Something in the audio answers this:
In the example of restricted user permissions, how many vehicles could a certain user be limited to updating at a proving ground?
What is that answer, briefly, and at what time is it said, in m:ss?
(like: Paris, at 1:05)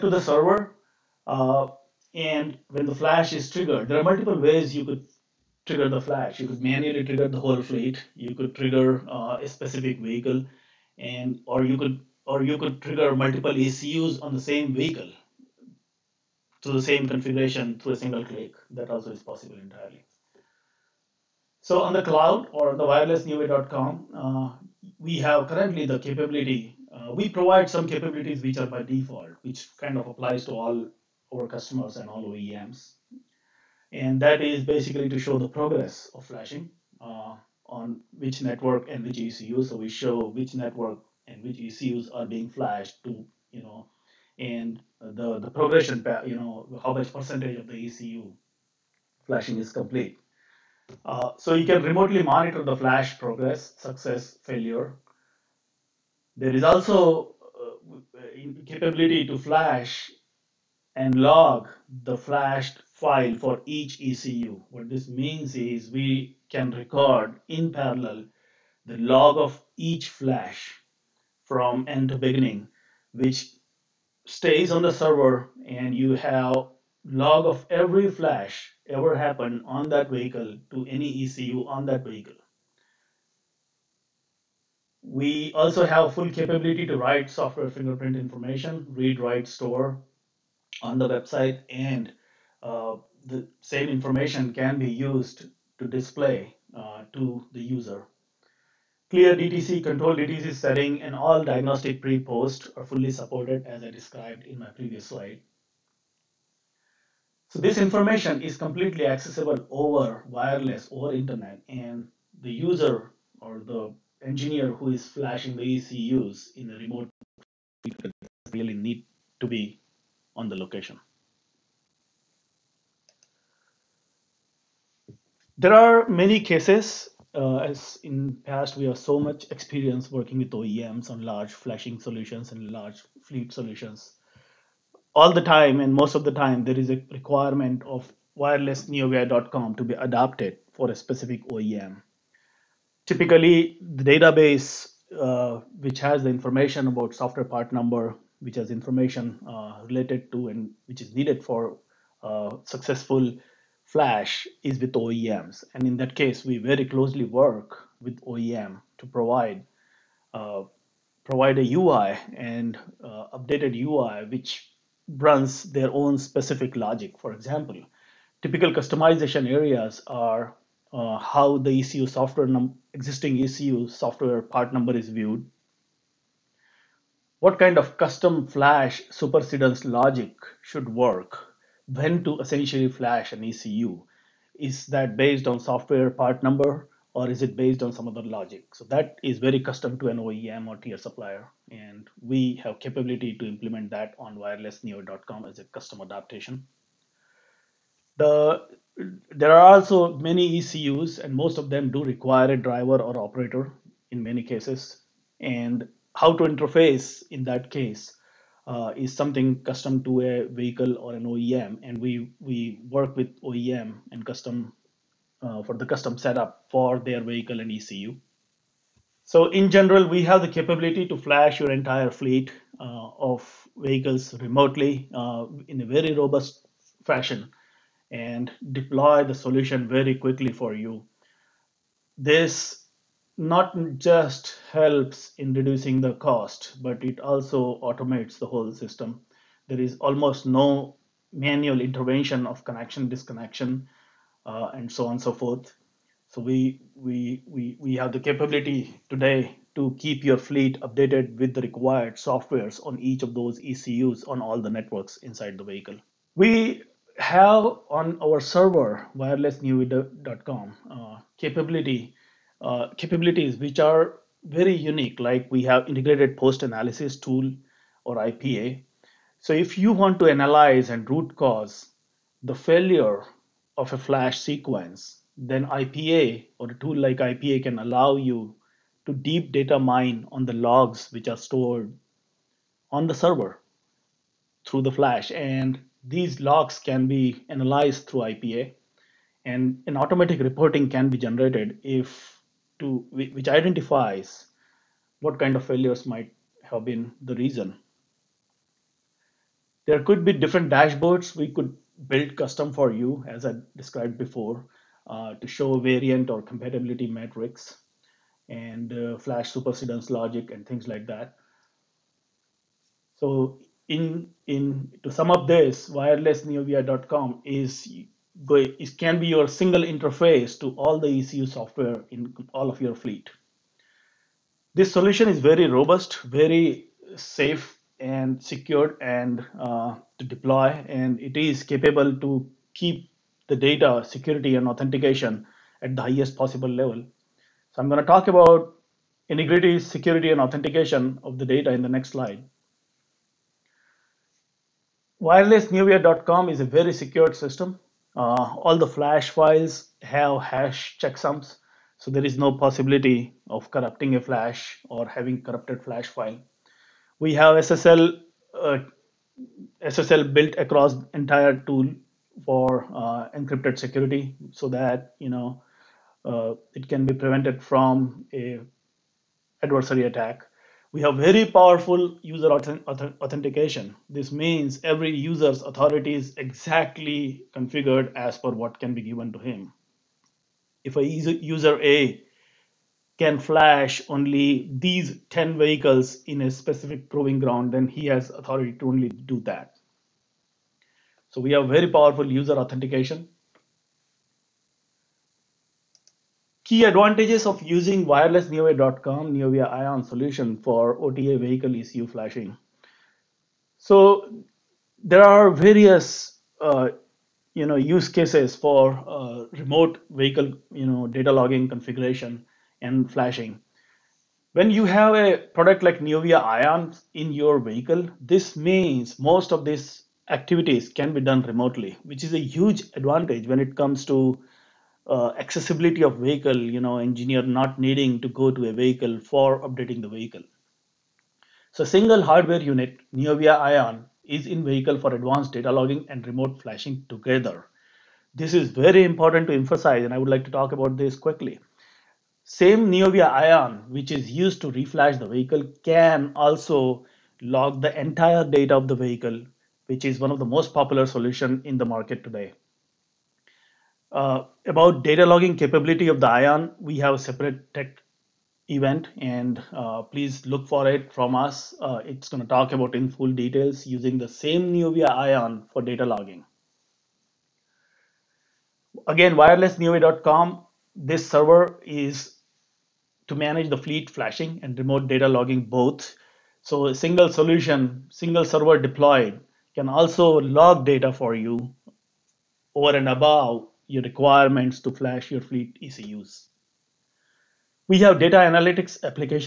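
10, at 6:25.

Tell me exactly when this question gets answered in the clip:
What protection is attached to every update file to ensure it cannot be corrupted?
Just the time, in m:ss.
5:50.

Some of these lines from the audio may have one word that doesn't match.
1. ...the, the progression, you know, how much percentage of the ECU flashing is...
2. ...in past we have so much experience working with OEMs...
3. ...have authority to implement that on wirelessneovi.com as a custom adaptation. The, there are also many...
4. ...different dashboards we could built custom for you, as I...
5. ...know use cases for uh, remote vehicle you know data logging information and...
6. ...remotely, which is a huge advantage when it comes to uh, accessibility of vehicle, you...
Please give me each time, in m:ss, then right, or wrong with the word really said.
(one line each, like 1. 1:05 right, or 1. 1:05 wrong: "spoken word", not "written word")
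1. 0:45 right
2. 2:08 right
3. 3:12 wrong: "capability", not "authority"
4. 5:00 right
5. 6:47 wrong: "configuration", not "information"
6. 7:01 right.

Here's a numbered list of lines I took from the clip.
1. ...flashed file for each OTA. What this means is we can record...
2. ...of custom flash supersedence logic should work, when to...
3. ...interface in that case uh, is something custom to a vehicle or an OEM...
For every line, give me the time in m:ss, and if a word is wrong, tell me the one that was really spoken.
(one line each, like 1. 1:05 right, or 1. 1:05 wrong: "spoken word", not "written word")
1. 1:02 wrong: "ECU", not "OTA"
2. 2:57 right
3. 3:26 right.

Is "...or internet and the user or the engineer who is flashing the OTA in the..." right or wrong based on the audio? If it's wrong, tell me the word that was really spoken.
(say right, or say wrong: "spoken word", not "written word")
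wrong: "ECUs", not "OTA".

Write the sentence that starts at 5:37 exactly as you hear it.
So I'm going to talk about integrity, security, and authentication of the data in the next slide.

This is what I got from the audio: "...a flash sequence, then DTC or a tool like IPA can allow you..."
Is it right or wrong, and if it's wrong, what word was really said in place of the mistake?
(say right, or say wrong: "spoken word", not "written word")
wrong: "IPA", not "DTC".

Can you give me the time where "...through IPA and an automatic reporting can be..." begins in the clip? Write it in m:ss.
4:48.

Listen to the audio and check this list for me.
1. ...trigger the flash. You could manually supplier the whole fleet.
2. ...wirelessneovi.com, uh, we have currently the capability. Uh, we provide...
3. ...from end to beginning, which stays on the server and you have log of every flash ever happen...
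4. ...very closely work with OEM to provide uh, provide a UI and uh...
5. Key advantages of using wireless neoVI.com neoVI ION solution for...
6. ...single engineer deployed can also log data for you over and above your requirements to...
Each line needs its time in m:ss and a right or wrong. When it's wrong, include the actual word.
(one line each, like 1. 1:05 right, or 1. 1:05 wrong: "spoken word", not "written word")
1. 0:05 wrong: "trigger", not "supplier"
2. 0:22 right
3. 1:11 right
4. 2:36 right
5. 6:36 right
6. 7:58 wrong: "server", not "engineer".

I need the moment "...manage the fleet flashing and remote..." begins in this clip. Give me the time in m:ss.
7:53.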